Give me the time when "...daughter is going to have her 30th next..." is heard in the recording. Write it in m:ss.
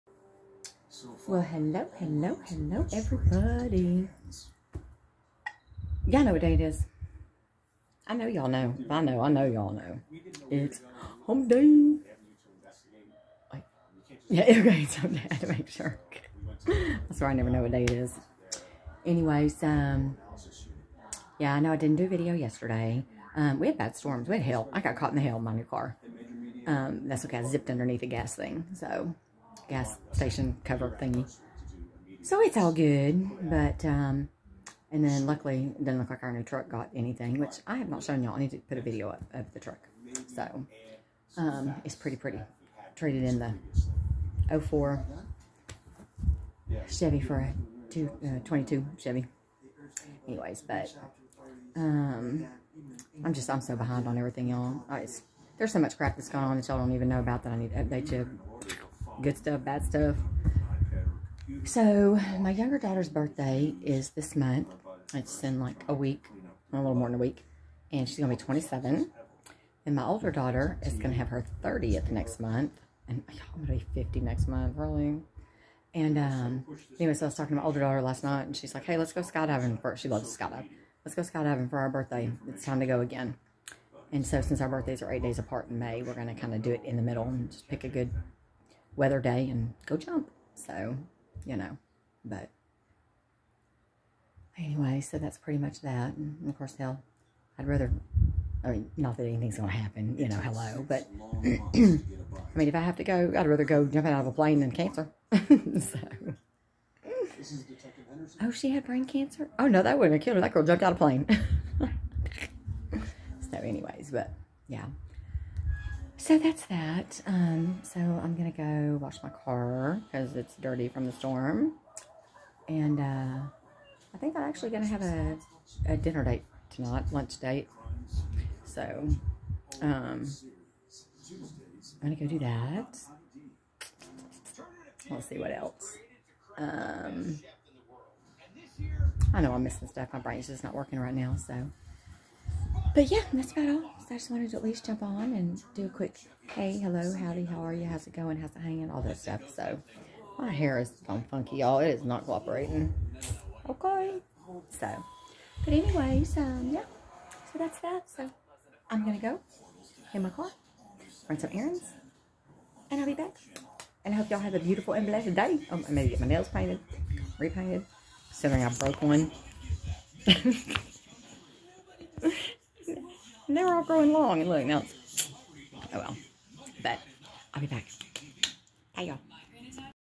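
1:10.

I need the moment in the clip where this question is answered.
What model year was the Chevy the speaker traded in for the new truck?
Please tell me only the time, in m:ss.
0:44.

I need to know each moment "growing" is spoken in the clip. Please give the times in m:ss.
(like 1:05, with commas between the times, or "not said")
2:53.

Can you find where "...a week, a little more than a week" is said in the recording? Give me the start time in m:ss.
1:05.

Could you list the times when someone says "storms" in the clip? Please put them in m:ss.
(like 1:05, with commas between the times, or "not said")
0:23, 2:01.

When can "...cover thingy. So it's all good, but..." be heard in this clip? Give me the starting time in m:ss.
0:30.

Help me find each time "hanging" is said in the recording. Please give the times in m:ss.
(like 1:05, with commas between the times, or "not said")
2:28.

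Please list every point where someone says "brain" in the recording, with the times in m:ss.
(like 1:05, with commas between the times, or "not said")
1:48, 2:20.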